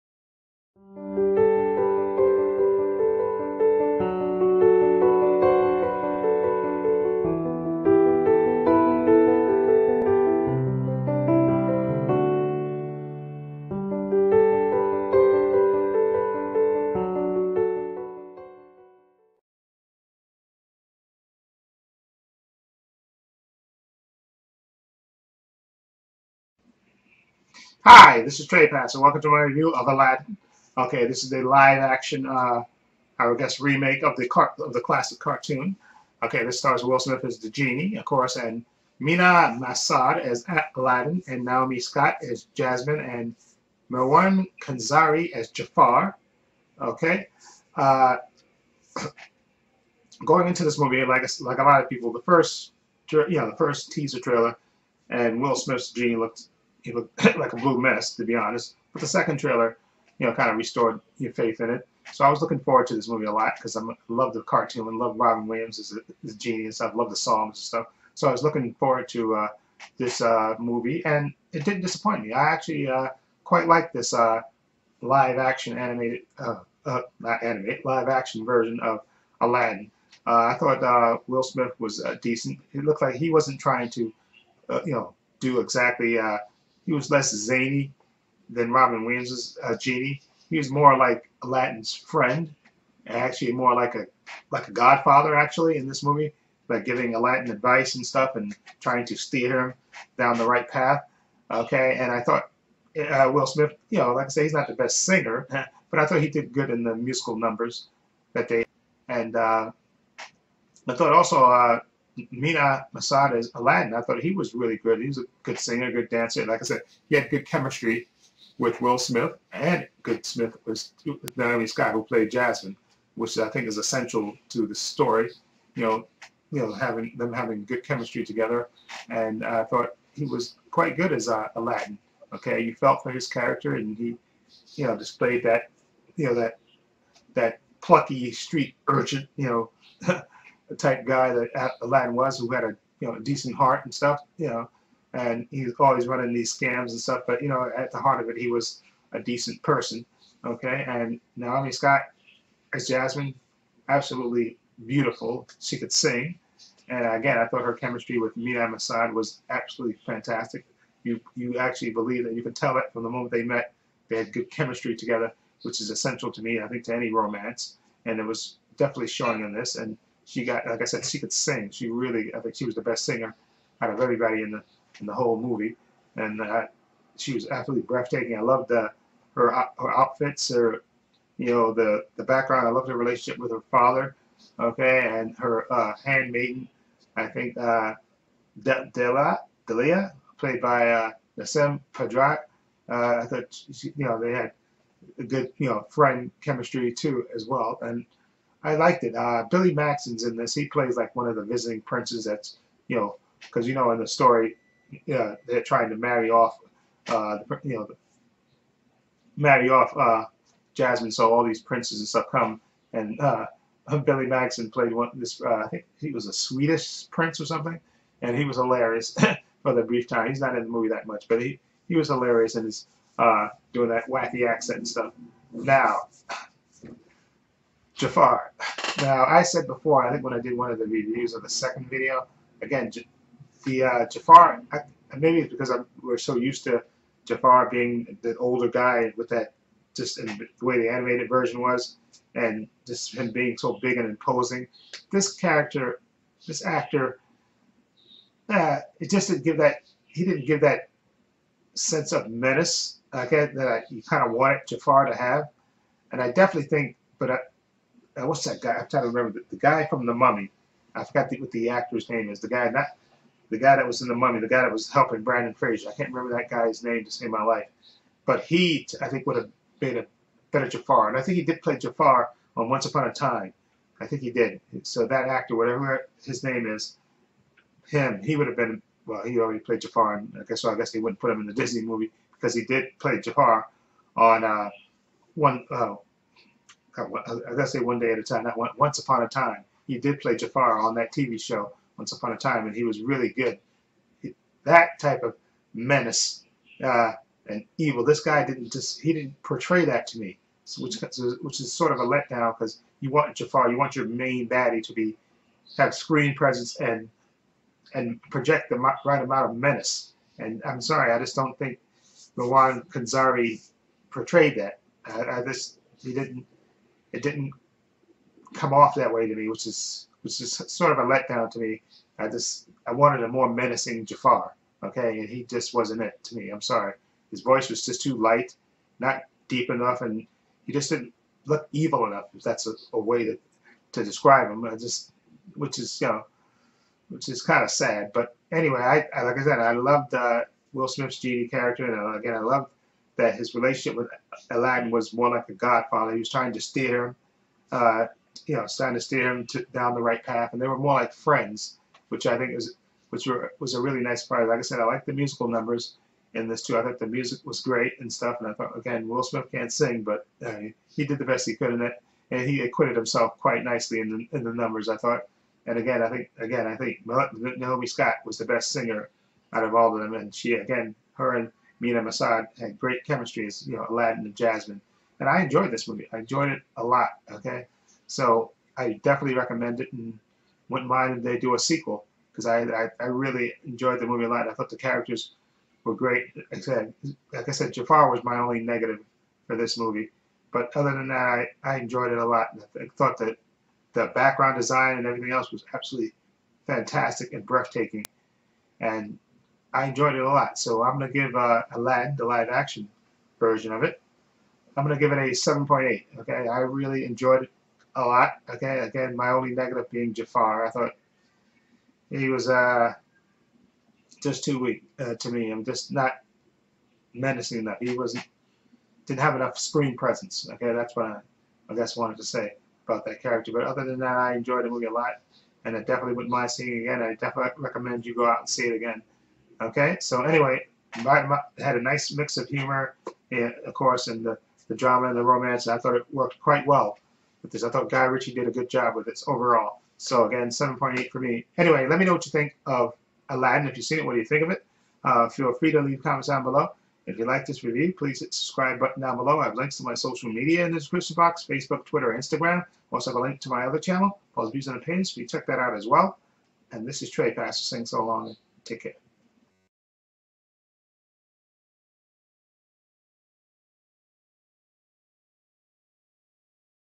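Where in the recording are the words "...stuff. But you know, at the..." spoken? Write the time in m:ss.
2:27.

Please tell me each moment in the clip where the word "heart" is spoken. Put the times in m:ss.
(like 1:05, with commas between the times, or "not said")
2:23, 2:27.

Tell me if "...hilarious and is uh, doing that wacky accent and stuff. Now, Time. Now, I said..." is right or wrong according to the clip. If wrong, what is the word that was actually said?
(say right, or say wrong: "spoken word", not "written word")
wrong: "Jafar", not "Time".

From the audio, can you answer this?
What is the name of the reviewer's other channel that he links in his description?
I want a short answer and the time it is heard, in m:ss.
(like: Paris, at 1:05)
Paul's Views, at 7:34.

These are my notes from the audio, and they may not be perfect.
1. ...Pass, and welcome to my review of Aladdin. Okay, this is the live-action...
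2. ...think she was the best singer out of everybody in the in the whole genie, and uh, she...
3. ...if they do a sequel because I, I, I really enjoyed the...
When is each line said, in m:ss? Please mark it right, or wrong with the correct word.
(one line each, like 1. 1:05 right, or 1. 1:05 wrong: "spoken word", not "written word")
1. 0:28 right
2. 2:52 wrong: "movie", not "genie"
3. 6:21 right.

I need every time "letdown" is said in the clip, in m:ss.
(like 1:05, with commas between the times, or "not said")
5:02, 5:21.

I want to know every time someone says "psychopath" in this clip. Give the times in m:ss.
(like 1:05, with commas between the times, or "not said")
not said.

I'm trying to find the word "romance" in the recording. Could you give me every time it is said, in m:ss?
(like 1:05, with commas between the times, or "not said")
2:47, 7:15.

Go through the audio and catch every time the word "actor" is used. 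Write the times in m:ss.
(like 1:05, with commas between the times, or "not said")
4:06, 4:21, 4:35.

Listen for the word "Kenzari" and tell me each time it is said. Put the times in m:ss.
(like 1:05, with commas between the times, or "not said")
5:12.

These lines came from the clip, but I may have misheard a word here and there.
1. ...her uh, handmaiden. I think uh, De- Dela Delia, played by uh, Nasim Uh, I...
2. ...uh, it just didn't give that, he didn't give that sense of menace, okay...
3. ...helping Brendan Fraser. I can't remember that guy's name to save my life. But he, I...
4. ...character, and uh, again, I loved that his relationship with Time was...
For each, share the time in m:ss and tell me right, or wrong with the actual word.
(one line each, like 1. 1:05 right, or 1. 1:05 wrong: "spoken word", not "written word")
1. 3:05 right
2. 4:08 right
3. 4:24 right
4. 5:41 wrong: "Aladdin", not "Time".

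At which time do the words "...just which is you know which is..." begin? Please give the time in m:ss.
5:34.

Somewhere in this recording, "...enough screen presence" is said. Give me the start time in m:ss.
6:59.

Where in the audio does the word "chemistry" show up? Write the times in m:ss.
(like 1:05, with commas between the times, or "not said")
1:57, 2:07, 2:37, 2:44, 3:16, 6:13.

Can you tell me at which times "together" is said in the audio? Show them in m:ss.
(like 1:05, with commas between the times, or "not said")
2:08, 2:44.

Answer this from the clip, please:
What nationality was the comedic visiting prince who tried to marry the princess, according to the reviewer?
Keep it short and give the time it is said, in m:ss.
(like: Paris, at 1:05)
Swedish, at 3:36.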